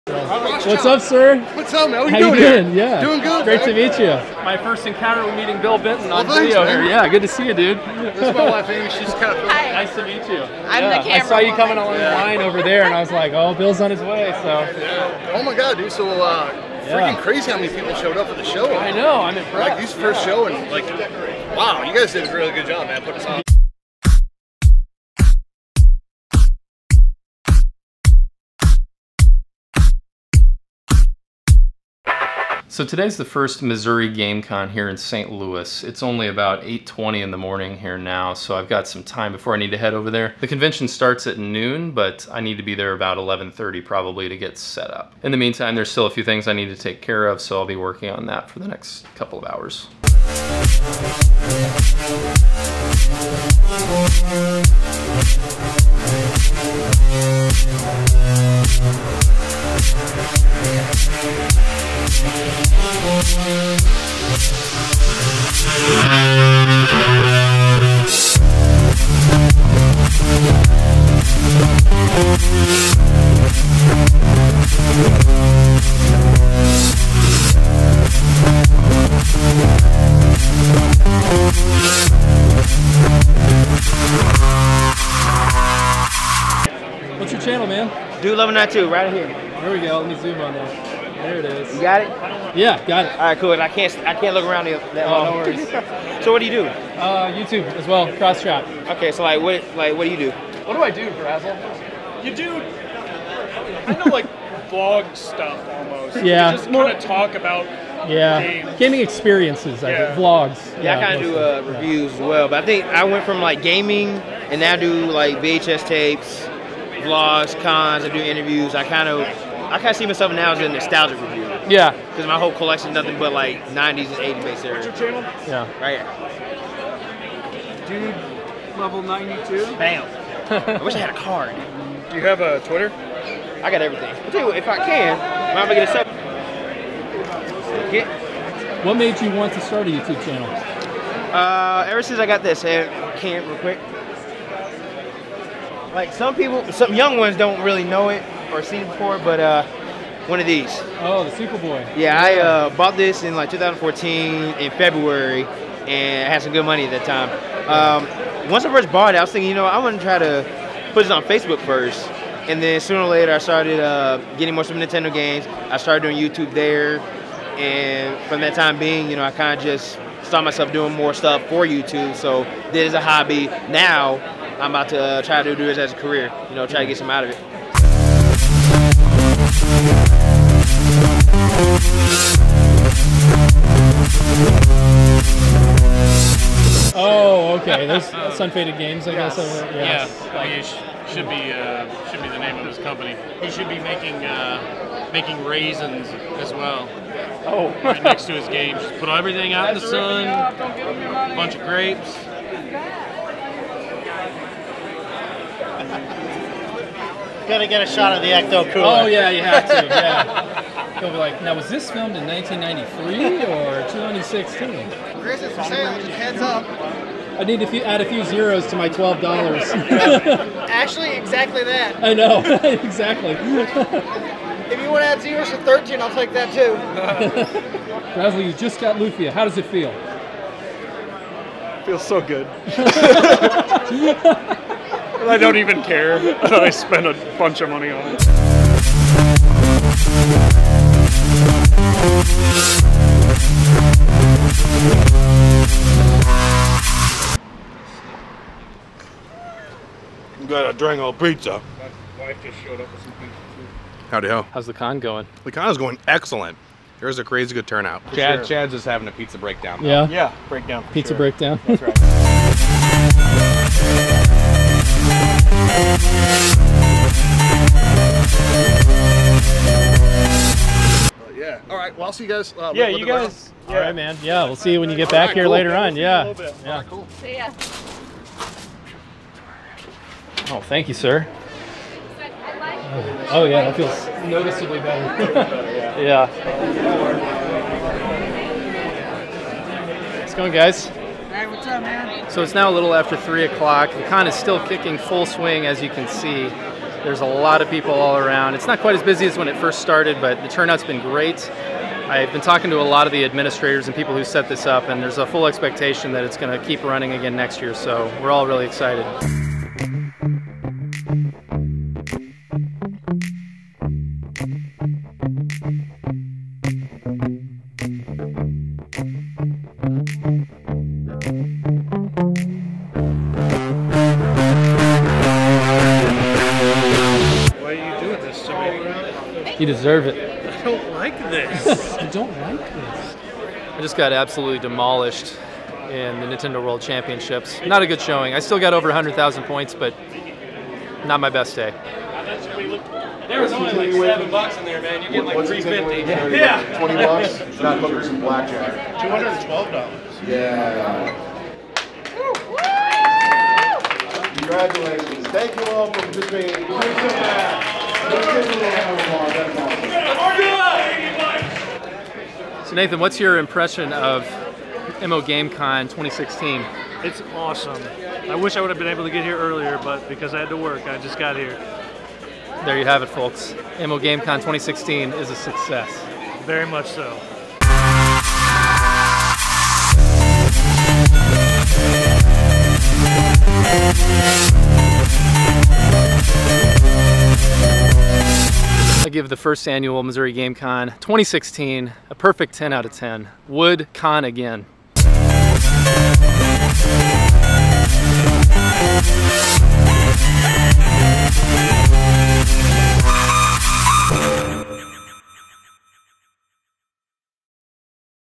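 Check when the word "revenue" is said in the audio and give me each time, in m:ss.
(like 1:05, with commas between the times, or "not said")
not said.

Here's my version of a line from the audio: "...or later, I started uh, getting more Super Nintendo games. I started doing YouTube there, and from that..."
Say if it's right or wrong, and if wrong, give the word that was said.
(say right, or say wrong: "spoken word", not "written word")
right.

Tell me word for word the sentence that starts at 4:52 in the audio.
So it's now a little after 3 o'clock.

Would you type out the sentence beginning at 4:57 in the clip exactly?
There's a lot of people all around.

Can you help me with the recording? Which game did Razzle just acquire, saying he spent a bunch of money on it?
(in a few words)
Lufia.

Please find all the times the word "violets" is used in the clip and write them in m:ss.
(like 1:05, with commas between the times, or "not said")
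not said.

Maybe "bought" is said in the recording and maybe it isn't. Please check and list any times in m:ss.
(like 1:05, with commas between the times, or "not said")
2:32, 2:38.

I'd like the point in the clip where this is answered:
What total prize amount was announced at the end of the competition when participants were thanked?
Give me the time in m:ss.
5:48.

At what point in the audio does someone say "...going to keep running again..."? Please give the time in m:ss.
5:06.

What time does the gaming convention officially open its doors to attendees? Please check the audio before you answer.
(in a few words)
Noon.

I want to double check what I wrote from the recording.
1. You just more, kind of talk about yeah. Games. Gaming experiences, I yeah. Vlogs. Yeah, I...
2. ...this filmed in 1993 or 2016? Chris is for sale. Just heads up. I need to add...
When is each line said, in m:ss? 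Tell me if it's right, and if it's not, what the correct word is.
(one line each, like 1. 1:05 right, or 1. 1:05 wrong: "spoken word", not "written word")
1. 1:46 right
2. 3:31 right.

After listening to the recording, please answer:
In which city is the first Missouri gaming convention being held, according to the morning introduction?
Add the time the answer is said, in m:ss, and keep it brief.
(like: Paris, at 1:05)
St. Louis, at 0:34.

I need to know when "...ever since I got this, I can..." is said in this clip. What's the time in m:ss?
2:21.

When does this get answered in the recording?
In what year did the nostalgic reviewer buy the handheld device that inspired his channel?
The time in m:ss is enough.
2:33.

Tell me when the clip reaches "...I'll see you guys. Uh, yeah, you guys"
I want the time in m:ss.
4:32.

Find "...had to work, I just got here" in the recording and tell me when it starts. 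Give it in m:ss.
6:10.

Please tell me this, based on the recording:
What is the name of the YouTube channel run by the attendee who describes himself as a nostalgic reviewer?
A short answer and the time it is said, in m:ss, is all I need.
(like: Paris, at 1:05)
Cross Chop, at 1:38.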